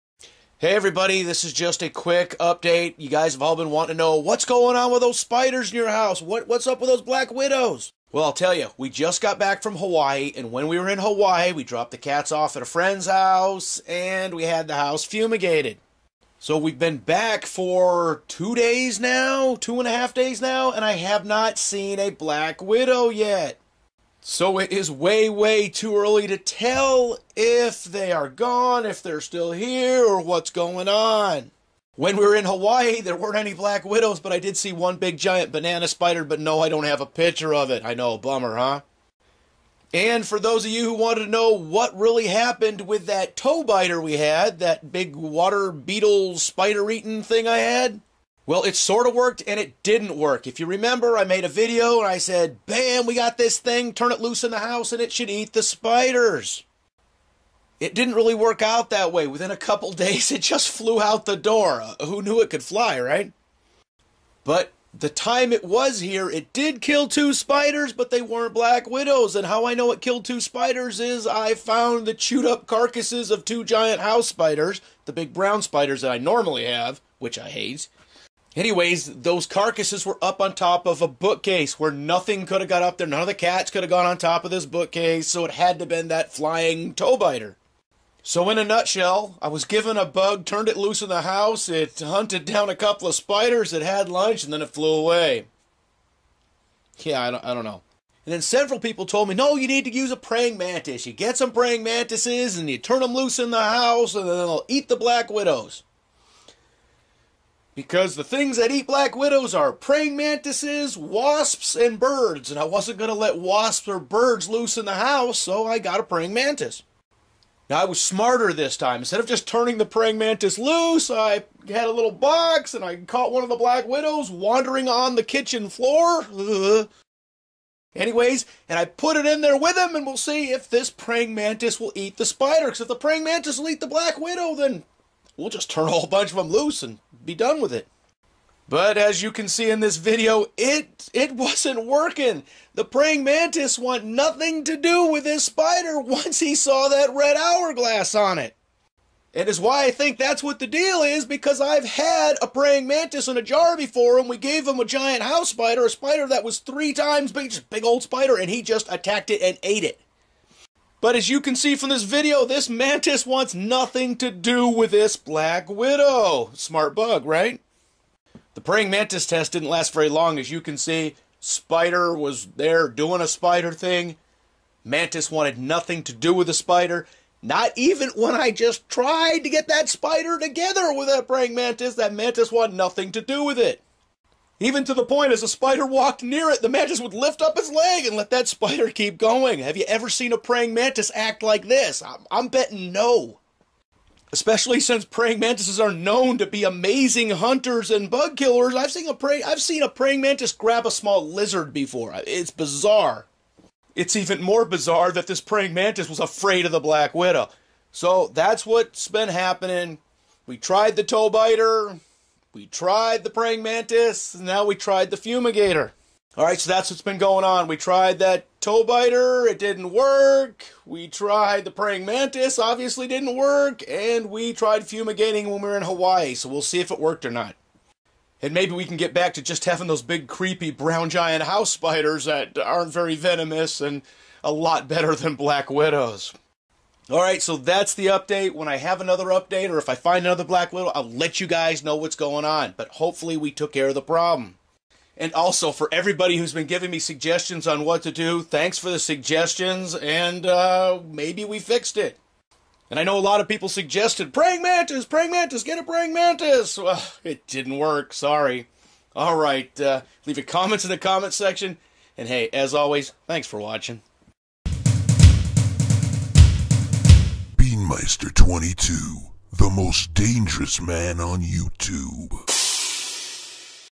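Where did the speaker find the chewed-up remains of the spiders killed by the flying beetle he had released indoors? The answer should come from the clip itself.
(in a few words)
top of a bookcase.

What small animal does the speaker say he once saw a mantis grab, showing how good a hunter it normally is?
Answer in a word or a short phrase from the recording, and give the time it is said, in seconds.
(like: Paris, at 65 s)
small lizard, at 200 s.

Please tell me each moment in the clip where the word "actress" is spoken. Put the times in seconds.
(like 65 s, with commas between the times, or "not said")
not said.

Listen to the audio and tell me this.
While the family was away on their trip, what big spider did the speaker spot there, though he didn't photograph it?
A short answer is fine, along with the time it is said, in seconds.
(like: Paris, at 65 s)
banana spider, at 35 s.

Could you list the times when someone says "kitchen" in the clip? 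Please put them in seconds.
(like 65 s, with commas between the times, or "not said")
125 s.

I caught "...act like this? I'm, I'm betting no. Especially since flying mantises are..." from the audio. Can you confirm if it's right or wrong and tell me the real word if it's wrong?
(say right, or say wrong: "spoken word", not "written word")
wrong: "praying", not "flying".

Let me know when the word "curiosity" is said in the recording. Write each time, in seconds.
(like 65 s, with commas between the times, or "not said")
not said.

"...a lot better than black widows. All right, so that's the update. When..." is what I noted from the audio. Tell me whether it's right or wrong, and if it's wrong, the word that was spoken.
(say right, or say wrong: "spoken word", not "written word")
right.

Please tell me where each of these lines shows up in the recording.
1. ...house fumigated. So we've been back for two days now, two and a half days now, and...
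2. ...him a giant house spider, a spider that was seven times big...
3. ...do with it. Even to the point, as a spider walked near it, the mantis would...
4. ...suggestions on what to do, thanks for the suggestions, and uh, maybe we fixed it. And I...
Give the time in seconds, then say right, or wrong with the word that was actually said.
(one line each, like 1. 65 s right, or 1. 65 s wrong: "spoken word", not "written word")
1. 14 s right
2. 154 s wrong: "three", not "seven"
3. 183 s right
4. 246 s right.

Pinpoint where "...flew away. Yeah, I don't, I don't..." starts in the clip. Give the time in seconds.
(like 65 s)
94 s.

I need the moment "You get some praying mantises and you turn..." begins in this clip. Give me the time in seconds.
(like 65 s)
101 s.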